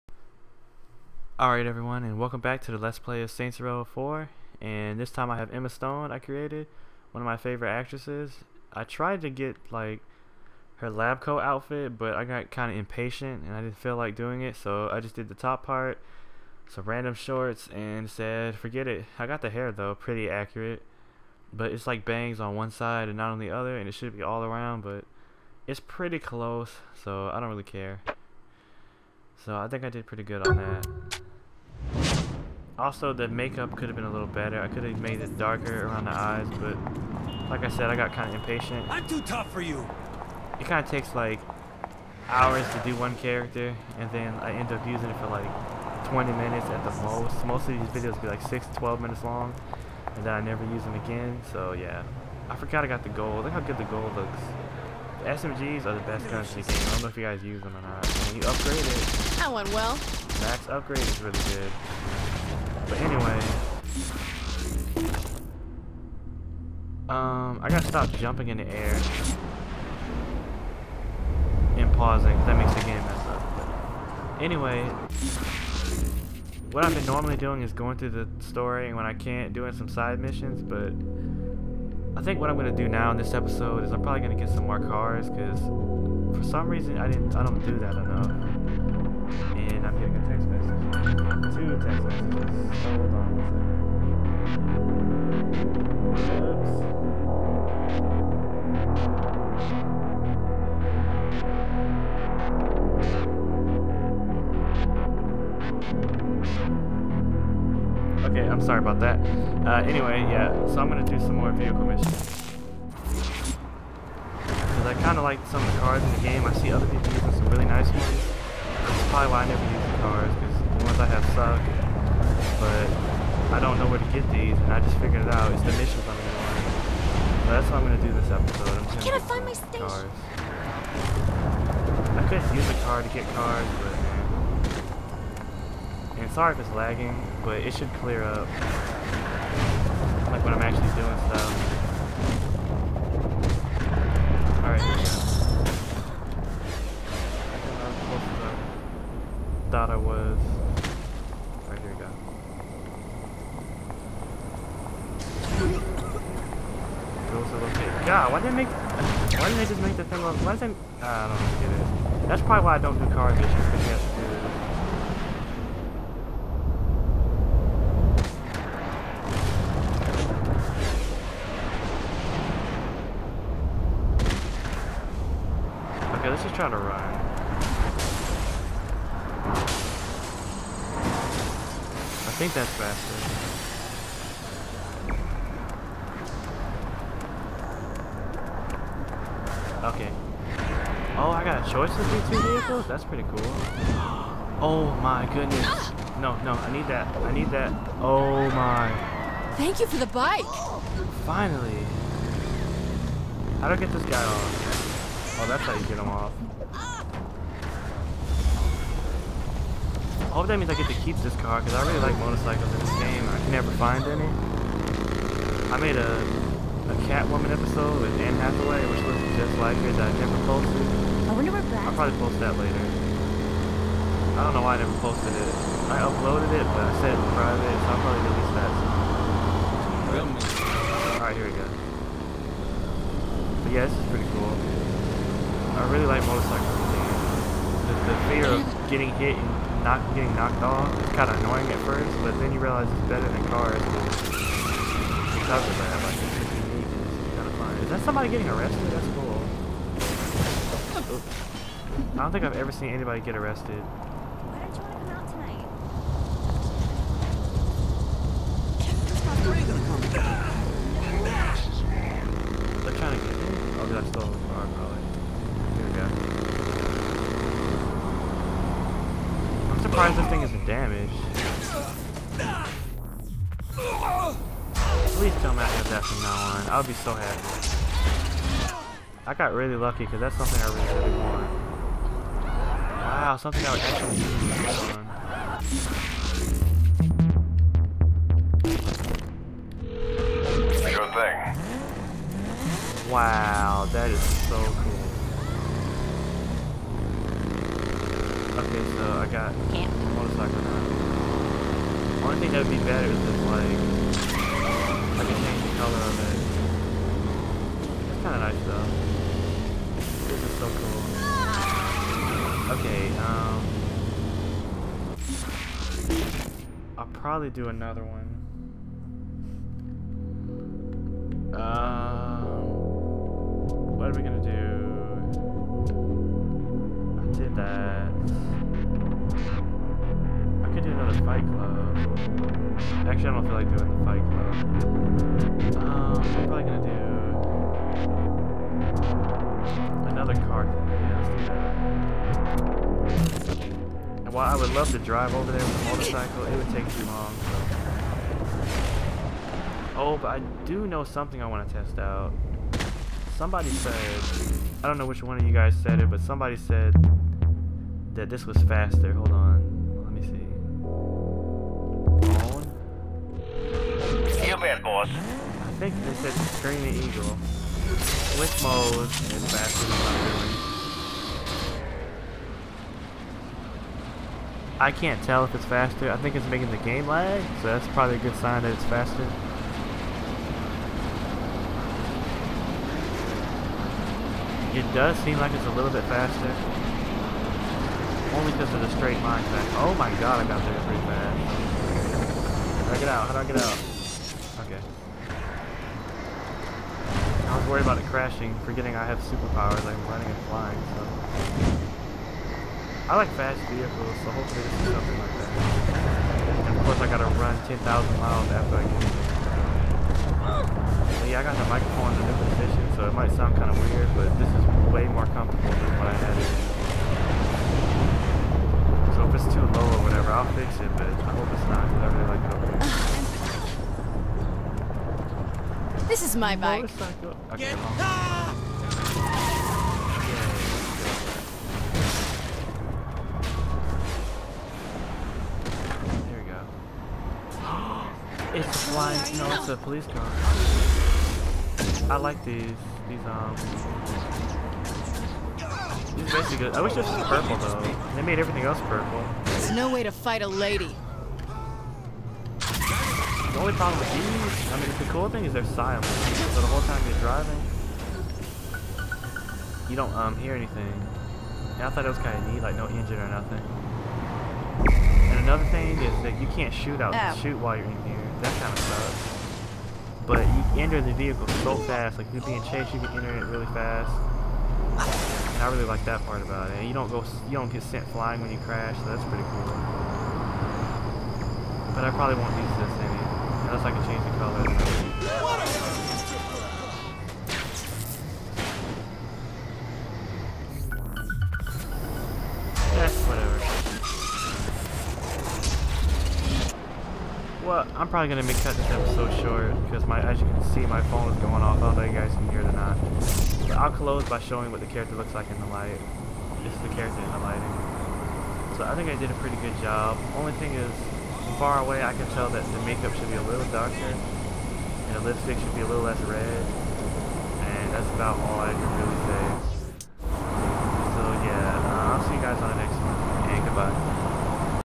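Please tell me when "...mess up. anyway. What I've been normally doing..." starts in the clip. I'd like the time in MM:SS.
01:12.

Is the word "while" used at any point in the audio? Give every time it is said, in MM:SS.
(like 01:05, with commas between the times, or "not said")
05:44, 07:47.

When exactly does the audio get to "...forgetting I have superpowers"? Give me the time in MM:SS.
06:38.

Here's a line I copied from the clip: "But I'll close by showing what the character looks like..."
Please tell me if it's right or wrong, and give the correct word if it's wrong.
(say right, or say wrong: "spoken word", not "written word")
right.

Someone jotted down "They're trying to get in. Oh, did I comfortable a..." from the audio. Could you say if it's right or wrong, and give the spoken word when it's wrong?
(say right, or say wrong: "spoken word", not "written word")
wrong: "stole", not "comfortable".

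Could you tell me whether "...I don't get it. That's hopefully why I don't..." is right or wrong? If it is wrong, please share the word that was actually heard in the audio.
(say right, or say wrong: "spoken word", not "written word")
wrong: "probably", not "hopefully".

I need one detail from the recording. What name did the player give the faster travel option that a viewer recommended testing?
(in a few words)
Green Eagle.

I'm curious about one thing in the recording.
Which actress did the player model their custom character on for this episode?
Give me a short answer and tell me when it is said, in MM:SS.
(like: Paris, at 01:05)
Emma Stone, at 00:05.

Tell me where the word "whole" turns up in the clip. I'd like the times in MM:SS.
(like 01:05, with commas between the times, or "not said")
07:36.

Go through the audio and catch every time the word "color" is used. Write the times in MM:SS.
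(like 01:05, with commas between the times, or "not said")
05:05, 08:04.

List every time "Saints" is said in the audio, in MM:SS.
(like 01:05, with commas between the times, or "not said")
00:03.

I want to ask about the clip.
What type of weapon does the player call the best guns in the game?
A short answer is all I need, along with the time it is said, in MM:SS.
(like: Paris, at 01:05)
SMGs, at 00:55.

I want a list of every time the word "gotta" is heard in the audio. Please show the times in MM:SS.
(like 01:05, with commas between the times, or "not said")
01:07, 06:47.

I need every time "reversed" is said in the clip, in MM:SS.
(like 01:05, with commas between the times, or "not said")
not said.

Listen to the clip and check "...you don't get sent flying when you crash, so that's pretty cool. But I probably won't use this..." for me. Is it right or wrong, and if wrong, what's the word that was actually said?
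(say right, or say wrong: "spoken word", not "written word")
right.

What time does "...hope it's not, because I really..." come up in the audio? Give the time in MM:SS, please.
07:01.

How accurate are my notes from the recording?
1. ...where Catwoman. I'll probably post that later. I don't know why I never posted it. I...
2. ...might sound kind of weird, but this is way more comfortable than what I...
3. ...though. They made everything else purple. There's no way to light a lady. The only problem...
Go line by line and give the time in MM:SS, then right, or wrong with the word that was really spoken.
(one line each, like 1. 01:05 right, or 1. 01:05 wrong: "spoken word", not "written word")
1. 03:41 wrong: "Brad", not "Catwoman"
2. 06:53 right
3. 07:27 wrong: "fight", not "light".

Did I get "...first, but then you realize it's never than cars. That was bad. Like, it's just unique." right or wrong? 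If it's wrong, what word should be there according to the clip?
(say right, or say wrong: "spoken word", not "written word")
wrong: "better", not "never".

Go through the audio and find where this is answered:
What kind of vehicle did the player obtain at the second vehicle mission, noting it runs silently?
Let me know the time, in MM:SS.
07:19.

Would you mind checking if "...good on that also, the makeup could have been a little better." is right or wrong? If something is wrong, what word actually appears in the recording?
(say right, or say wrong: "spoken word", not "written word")
right.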